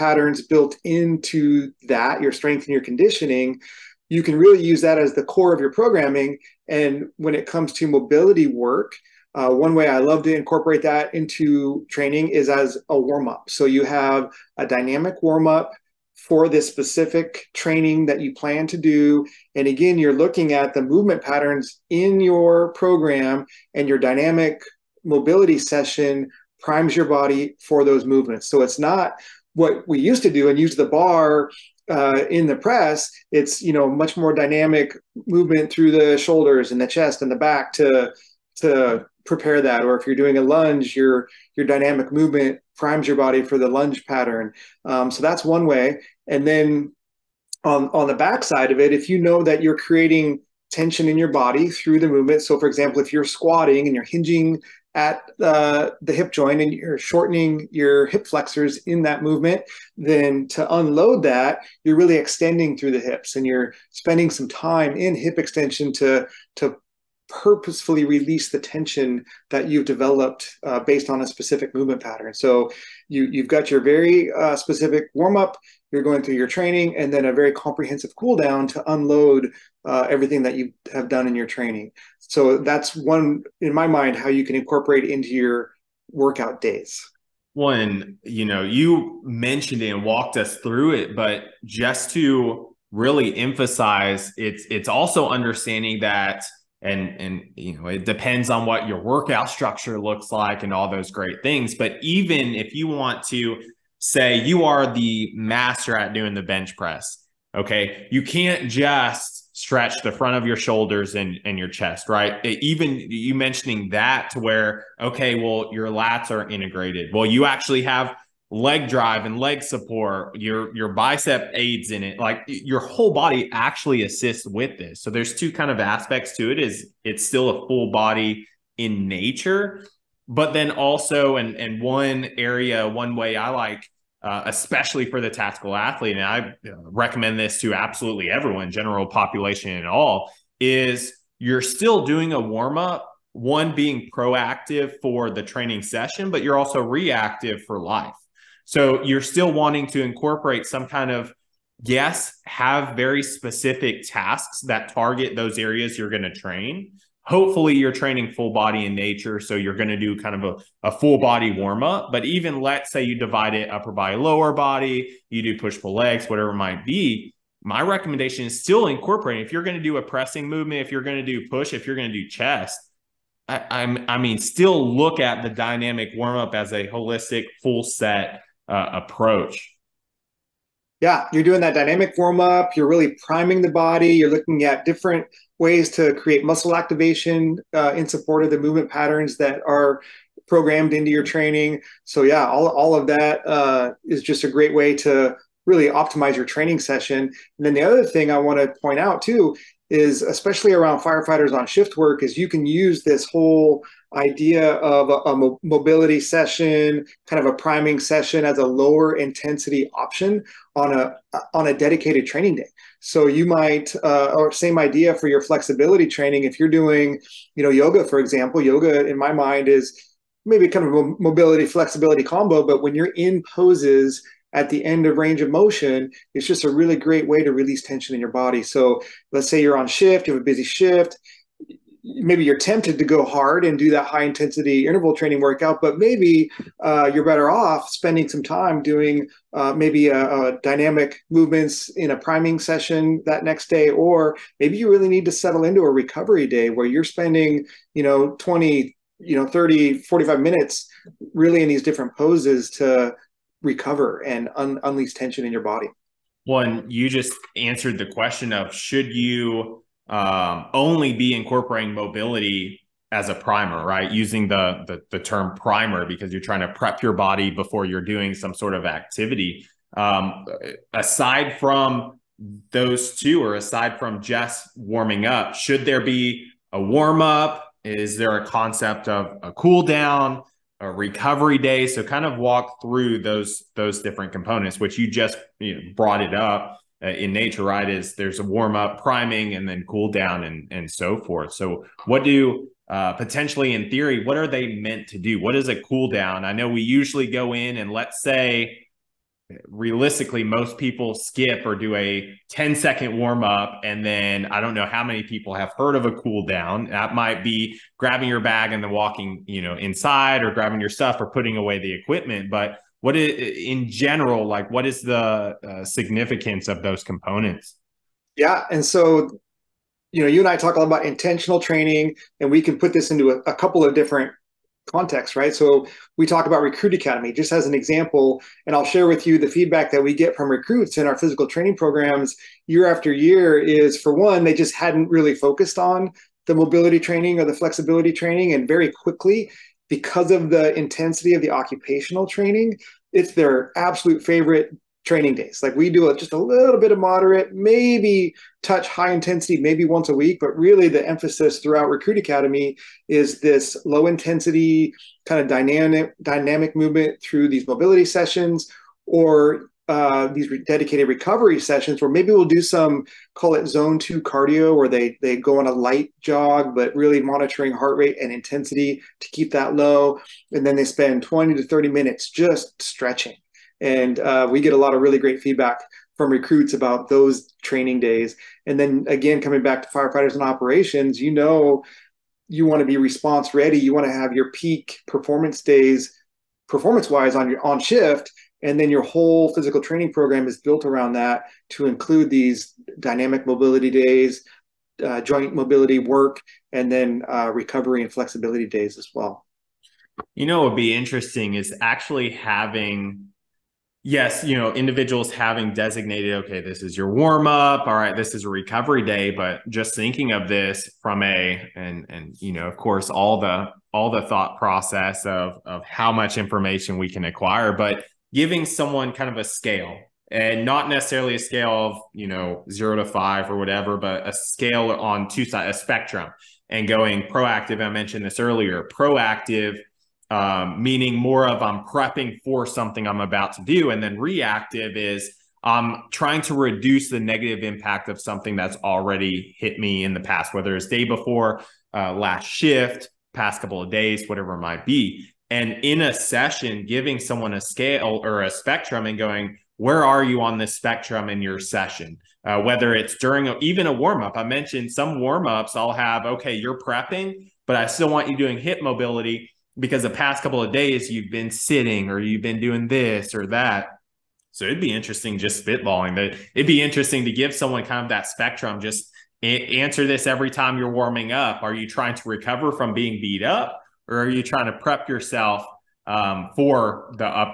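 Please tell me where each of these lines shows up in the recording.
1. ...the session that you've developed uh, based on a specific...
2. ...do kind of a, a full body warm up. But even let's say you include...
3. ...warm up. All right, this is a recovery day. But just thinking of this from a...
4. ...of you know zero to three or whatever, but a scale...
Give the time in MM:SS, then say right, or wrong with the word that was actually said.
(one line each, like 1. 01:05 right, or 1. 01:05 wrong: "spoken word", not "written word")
1. 01:08 wrong: "tension", not "session"
2. 02:39 wrong: "divide", not "include"
3. 06:47 right
4. 07:01 wrong: "five", not "three".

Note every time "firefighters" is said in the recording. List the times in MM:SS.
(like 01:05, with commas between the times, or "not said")
03:20, 06:19.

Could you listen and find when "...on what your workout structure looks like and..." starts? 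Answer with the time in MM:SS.
01:38.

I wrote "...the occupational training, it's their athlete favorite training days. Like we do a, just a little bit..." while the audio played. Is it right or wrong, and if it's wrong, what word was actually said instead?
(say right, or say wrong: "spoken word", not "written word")
wrong: "absolute", not "athlete".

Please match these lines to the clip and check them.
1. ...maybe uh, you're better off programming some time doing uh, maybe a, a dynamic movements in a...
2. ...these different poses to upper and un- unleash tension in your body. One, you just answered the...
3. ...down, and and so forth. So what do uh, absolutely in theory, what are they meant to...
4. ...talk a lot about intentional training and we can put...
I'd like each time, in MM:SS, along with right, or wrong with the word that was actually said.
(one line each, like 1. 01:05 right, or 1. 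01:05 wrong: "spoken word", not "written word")
1. 03:55 wrong: "spending", not "programming"
2. 04:11 wrong: "recover", not "upper"
3. 04:50 wrong: "potentially", not "absolutely"
4. 05:20 right.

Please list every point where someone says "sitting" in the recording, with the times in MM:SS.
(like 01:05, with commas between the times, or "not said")
07:41.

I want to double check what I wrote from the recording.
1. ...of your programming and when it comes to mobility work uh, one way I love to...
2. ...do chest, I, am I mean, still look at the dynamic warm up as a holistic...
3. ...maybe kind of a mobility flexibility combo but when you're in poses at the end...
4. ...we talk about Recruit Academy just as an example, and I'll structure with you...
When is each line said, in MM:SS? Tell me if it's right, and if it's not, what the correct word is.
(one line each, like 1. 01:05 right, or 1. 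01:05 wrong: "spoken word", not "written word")
1. 00:05 right
2. 02:52 right
3. 03:40 right
4. 05:26 wrong: "share", not "structure".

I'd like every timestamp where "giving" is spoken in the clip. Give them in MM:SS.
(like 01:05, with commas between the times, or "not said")
06:58, 07:26.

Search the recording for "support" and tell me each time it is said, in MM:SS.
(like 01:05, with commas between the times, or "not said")
01:59, 03:08.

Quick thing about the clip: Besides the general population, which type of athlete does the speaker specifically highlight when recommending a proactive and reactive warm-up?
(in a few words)
tactical athlete.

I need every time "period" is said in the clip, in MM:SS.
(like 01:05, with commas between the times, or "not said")
not said.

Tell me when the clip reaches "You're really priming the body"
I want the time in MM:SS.
03:02.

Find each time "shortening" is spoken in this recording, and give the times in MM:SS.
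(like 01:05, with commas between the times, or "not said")
00:56.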